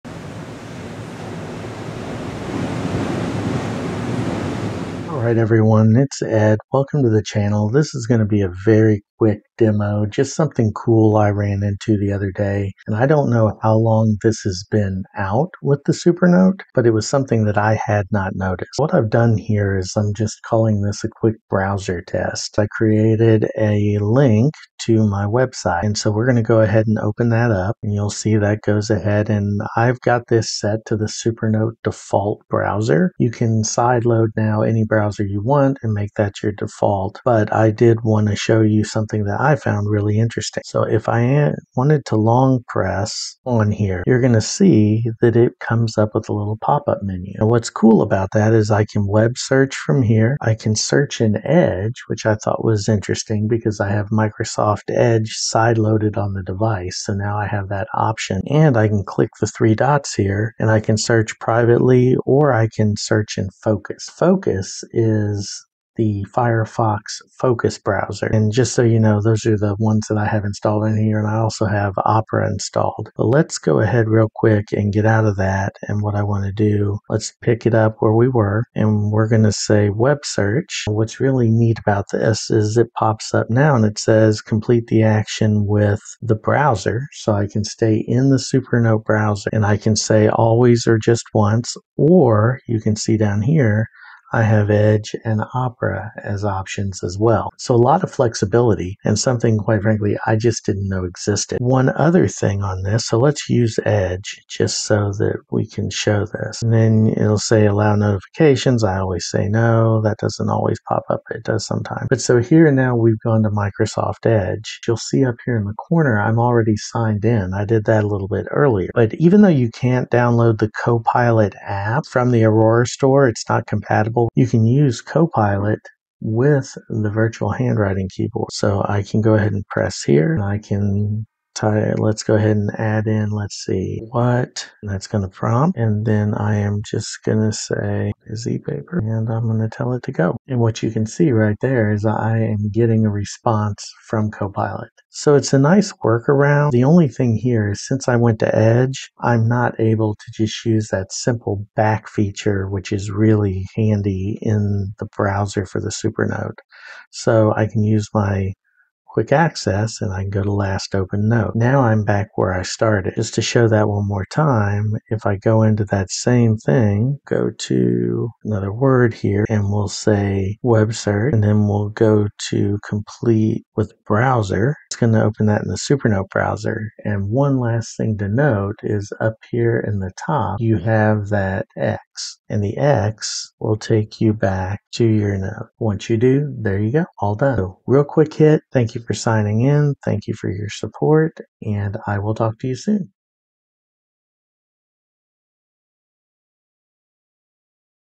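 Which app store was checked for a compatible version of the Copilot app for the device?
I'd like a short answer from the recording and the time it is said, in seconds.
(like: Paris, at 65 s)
Aurora store, at 122 s.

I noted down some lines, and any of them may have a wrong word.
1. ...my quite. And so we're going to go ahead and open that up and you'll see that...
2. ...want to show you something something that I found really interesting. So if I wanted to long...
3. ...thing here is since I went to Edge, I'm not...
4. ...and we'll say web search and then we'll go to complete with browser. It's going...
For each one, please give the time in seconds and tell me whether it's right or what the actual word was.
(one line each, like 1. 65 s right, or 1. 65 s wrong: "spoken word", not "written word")
1. 25 s wrong: "website", not "quite"
2. 38 s right
3. 147 s right
4. 169 s right.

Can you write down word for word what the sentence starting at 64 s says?
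Focus is the Firefox Focus browser.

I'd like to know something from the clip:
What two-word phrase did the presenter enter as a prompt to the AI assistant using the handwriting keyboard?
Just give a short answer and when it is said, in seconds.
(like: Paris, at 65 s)
busy paper, at 138 s.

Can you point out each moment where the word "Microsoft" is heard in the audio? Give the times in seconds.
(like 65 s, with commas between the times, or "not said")
54 s, 113 s.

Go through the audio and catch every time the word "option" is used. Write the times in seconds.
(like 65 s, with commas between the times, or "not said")
57 s, 96 s.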